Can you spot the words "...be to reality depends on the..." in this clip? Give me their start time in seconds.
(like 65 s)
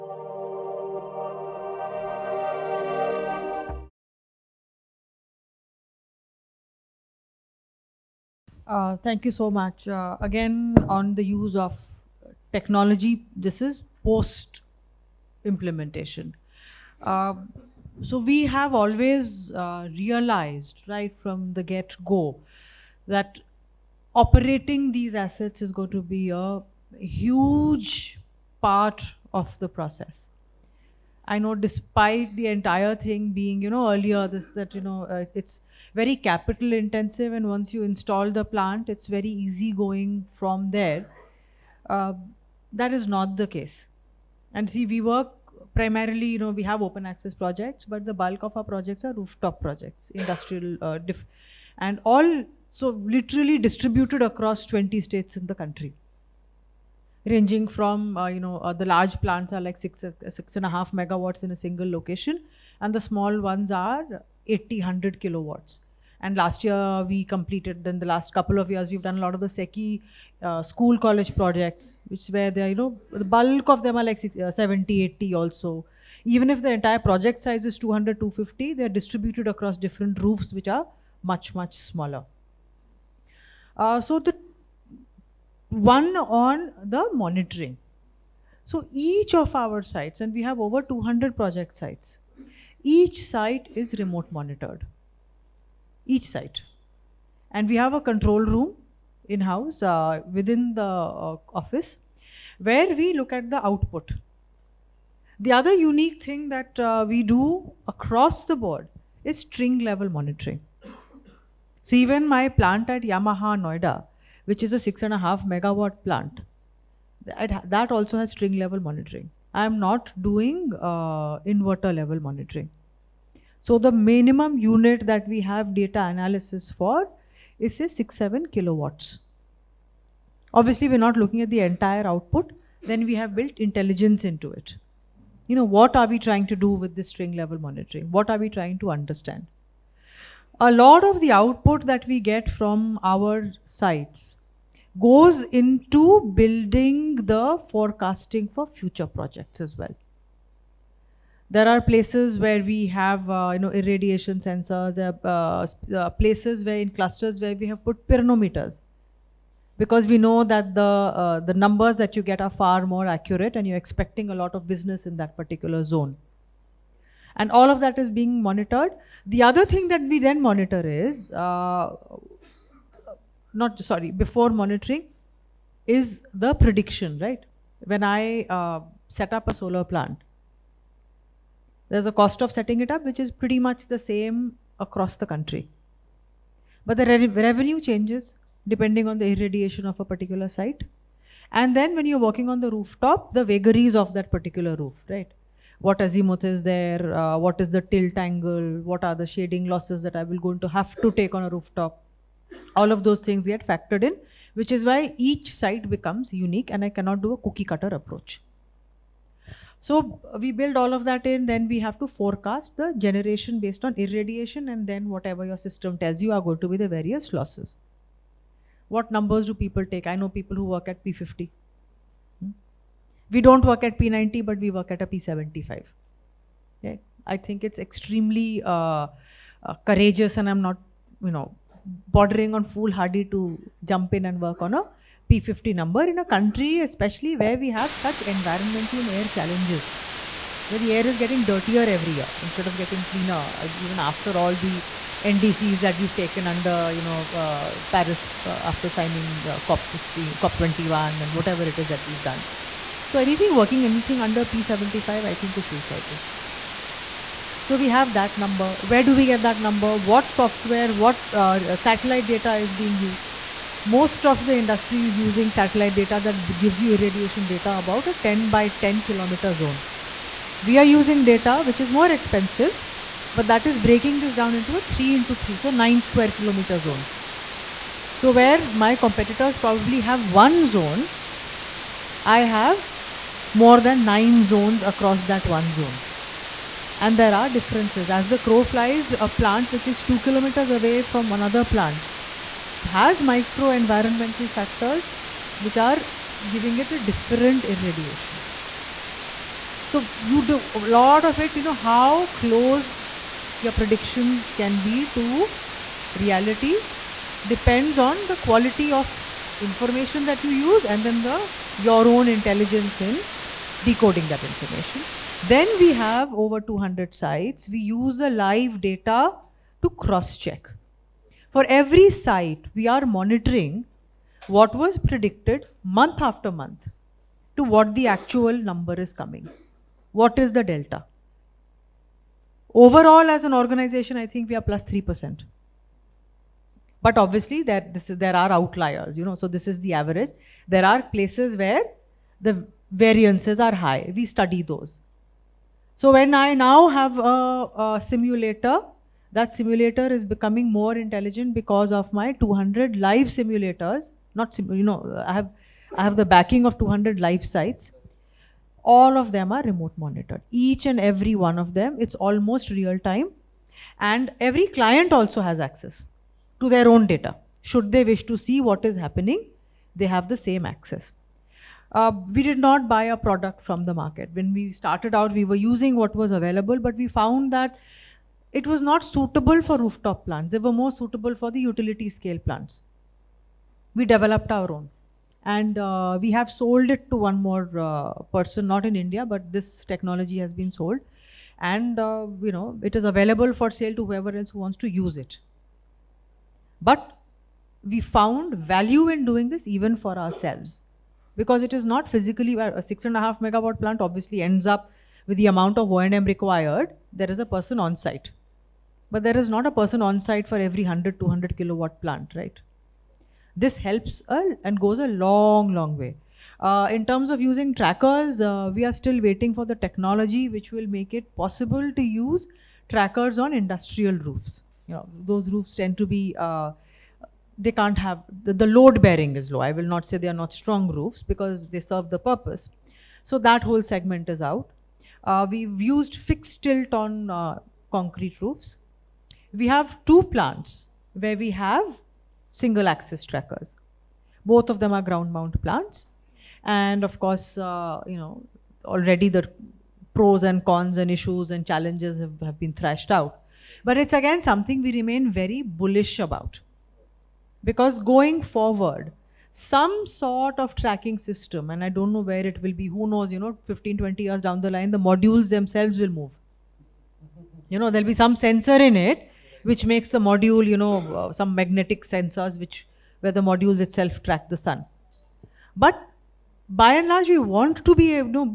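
304 s.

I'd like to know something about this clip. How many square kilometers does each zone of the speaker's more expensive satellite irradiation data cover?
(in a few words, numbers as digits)
9.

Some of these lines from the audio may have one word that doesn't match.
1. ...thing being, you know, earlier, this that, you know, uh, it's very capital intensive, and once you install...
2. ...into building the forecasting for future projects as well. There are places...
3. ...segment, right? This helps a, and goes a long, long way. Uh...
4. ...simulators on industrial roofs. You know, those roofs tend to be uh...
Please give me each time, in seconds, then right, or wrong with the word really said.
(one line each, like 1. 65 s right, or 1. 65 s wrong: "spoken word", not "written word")
1. 32 s right
2. 145 s right
3. 412 s wrong: "plant", not "segment"
4. 422 s wrong: "trackers", not "simulators".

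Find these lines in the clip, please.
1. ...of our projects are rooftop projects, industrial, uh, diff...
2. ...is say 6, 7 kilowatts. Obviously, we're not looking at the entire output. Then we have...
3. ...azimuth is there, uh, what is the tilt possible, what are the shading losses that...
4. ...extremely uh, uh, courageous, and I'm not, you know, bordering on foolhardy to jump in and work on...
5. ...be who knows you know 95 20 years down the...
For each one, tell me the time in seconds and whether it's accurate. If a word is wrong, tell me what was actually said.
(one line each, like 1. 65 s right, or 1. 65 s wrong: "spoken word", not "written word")
1. 48 s right
2. 127 s right
3. 196 s wrong: "angle", not "possible"
4. 227 s right
5. 462 s wrong: "15", not "95".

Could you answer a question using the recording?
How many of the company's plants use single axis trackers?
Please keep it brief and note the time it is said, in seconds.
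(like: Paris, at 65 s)
2, at 440 s.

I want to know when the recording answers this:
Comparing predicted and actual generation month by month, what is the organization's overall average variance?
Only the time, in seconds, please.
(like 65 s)
334 s.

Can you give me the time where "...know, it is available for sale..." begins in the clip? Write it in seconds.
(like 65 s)
392 s.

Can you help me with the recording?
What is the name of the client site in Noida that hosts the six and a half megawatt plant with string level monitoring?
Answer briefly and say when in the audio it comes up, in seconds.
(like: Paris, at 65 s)
Yamaha, at 113 s.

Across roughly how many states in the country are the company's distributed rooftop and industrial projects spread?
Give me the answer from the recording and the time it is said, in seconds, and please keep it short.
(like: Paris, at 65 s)
20, at 54 s.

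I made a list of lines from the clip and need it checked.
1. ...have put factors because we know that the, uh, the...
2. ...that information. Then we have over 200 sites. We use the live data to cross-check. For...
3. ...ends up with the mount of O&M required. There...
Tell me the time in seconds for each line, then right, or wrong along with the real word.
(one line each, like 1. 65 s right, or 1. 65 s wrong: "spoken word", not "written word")
1. 157 s wrong: "pyranometers", not "factors"
2. 314 s right
3. 404 s wrong: "amount", not "mount".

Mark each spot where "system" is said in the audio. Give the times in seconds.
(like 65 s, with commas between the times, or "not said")
215 s, 461 s.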